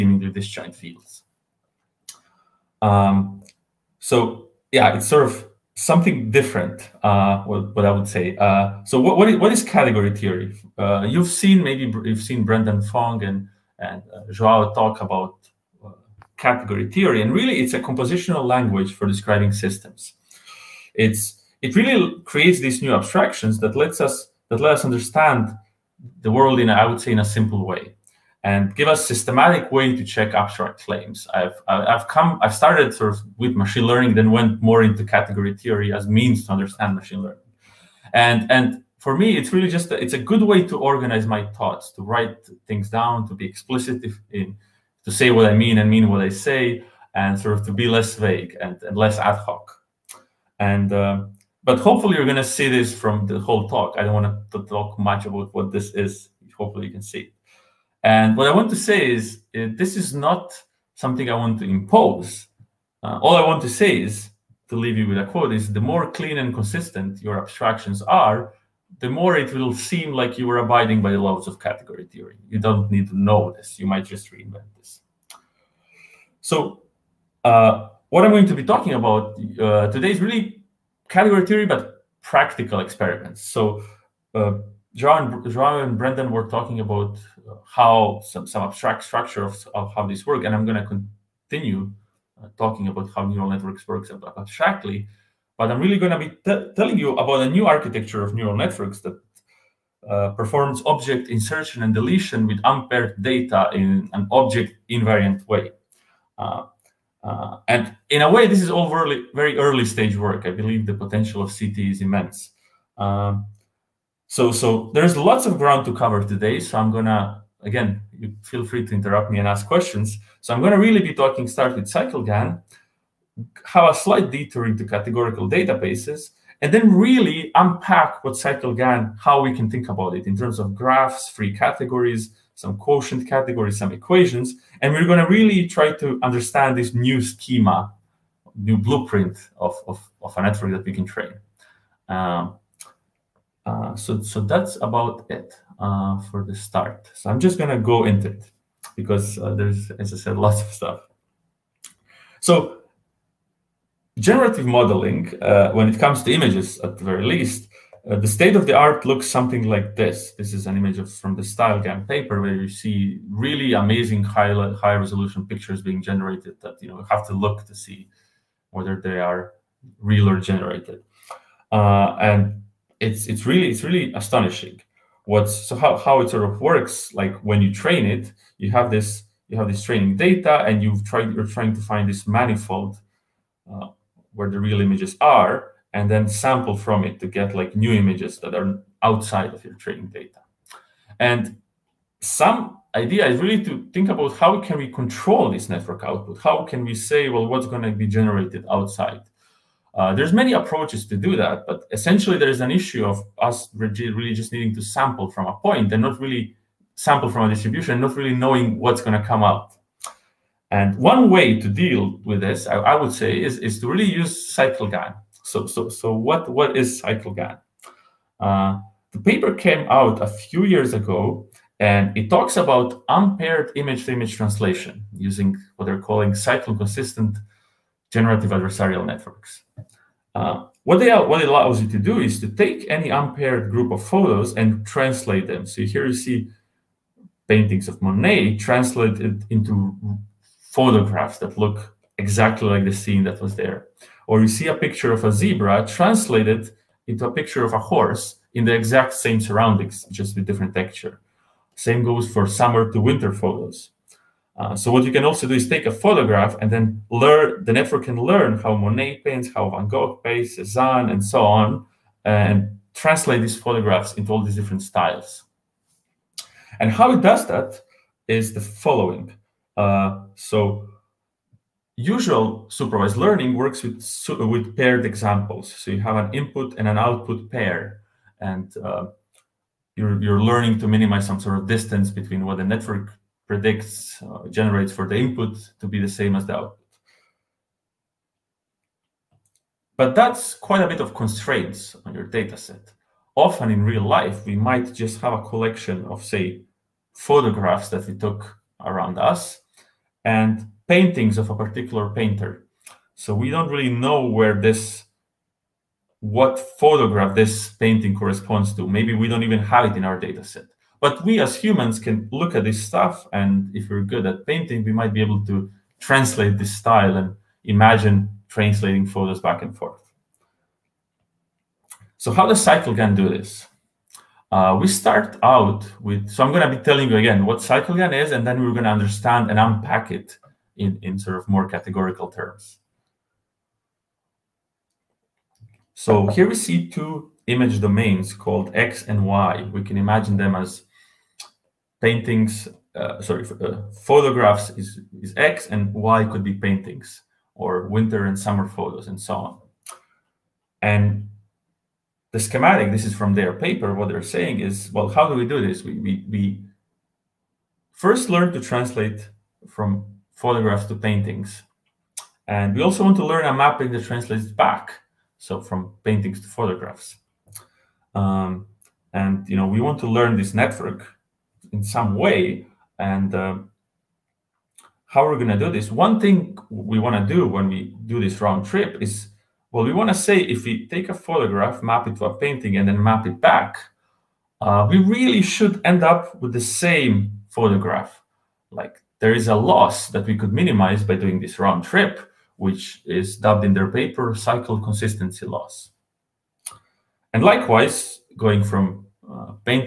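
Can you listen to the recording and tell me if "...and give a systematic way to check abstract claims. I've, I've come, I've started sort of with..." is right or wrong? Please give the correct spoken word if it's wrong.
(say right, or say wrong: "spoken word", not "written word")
right.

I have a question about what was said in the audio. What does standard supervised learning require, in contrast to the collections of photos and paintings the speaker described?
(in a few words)
Paired examples.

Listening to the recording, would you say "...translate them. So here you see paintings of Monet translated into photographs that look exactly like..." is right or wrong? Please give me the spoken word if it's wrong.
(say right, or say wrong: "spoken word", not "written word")
right.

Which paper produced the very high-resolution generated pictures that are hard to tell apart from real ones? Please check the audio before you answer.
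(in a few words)
StyleGAN.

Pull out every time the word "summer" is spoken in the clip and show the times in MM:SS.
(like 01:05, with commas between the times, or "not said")
04:12, 05:48.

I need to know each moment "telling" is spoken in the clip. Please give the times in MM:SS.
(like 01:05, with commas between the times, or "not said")
01:36, 05:26.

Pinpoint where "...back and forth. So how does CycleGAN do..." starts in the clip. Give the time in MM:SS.
05:19.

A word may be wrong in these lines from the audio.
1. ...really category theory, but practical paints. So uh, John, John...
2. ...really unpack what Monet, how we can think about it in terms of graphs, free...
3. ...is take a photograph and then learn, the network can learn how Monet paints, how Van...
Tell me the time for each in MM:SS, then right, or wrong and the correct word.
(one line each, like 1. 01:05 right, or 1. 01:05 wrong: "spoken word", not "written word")
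1. 01:20 wrong: "experiments", not "paints"
2. 02:06 wrong: "CycleGAN", not "Monet"
3. 04:15 right.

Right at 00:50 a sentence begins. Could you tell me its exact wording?
And, uh, but hopefully you're going to see this from the whole talk.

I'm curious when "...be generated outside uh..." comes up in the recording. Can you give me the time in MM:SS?
03:17.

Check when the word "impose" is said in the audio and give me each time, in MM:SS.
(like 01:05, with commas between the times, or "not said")
01:01.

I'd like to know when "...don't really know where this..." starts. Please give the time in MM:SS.
05:03.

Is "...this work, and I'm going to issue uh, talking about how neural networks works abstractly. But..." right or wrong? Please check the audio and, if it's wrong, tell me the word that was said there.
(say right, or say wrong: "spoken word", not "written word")
wrong: "continue", not "issue".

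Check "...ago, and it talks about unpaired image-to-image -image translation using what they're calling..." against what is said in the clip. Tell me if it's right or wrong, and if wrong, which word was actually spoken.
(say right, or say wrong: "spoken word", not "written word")
right.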